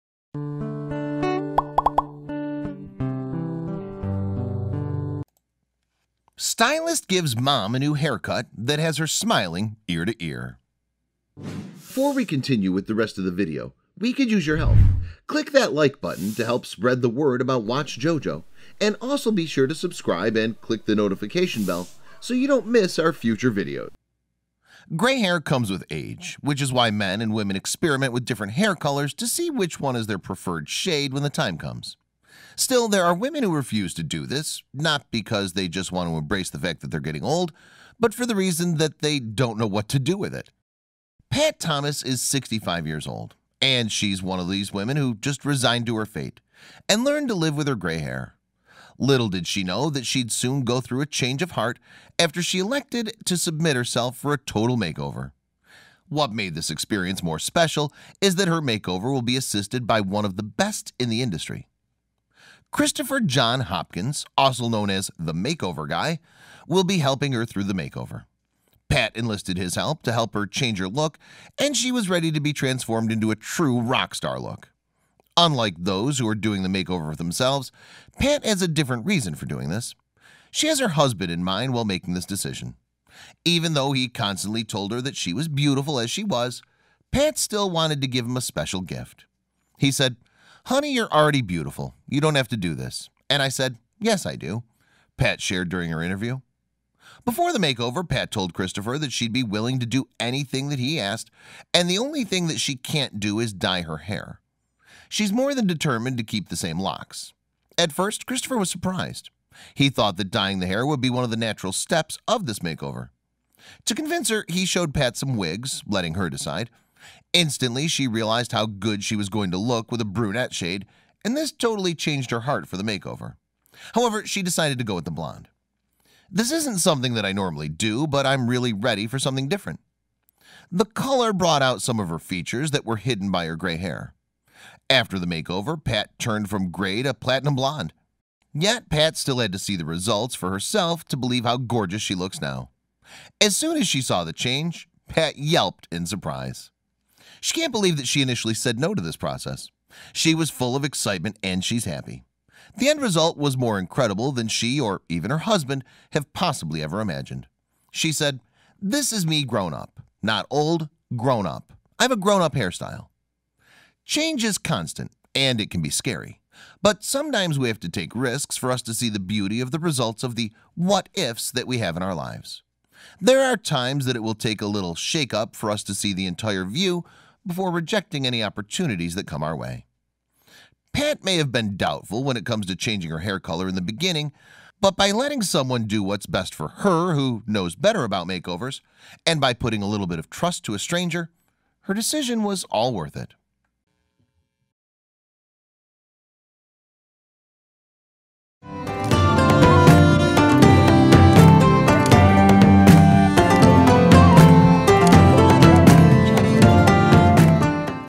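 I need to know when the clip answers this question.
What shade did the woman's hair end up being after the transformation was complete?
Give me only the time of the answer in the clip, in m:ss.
2:17.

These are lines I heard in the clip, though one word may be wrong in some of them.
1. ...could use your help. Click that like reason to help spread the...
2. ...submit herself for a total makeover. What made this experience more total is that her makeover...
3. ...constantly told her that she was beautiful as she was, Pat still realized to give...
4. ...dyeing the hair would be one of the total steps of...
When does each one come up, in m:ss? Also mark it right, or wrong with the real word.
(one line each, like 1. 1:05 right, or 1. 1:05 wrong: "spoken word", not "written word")
1. 0:14 wrong: "button", not "reason"
2. 0:53 wrong: "special", not "total"
3. 1:24 wrong: "wanted", not "realized"
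4. 1:50 wrong: "natural", not "total".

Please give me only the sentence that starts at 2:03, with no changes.
However, she decided to go with the blonde.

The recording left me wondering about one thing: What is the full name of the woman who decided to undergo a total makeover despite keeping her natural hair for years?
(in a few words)
Pat Thomas.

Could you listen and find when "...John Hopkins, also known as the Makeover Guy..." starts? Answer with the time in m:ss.
1:03.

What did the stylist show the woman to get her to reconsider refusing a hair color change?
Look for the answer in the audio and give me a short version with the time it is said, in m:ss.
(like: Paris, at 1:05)
Wigs, at 1:55.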